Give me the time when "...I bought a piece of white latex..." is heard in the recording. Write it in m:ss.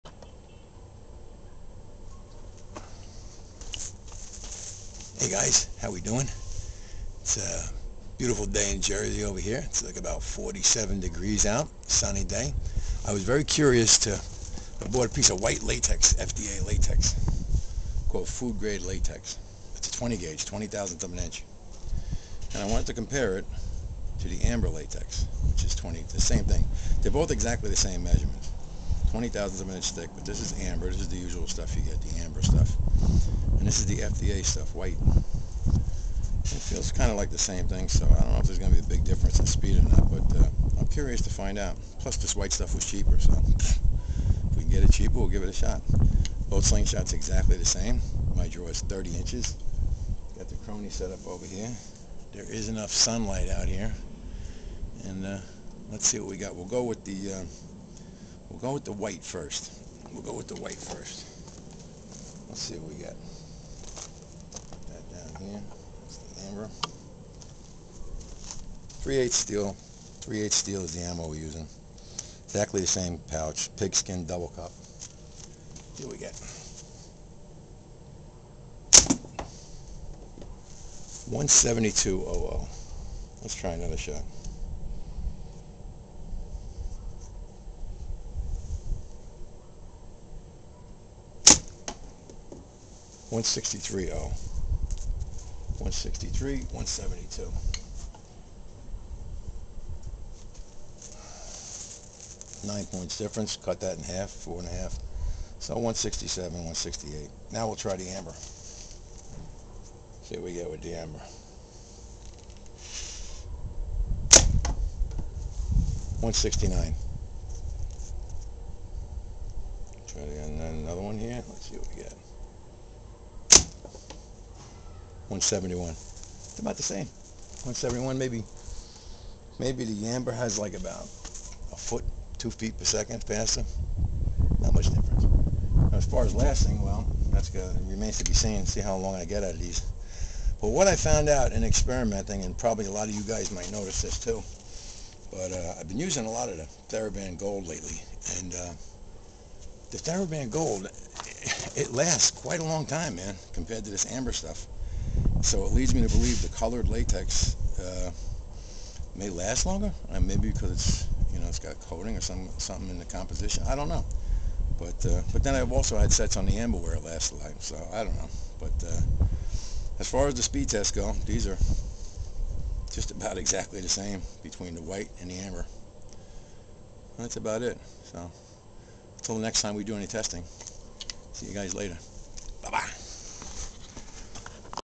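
0:14.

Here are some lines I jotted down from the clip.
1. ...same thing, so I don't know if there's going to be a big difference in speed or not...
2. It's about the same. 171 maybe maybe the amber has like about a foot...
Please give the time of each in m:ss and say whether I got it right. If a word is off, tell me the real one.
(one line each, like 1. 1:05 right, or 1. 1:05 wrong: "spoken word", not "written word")
1. 0:37 right
2. 2:05 right.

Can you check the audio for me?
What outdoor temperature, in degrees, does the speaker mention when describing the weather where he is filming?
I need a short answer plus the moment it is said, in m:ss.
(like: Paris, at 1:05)
47, at 0:10.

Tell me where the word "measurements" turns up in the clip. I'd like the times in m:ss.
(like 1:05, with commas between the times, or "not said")
0:28.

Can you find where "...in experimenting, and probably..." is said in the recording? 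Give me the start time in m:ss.
2:21.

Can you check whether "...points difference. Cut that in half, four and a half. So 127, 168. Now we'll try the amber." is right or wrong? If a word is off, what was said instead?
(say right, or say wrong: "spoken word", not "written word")
wrong: "167", not "127".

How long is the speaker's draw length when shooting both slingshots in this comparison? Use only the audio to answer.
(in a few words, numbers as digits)
30 inches.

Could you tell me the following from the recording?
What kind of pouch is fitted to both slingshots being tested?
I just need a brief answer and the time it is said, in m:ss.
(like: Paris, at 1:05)
Pigskin double cup, at 1:13.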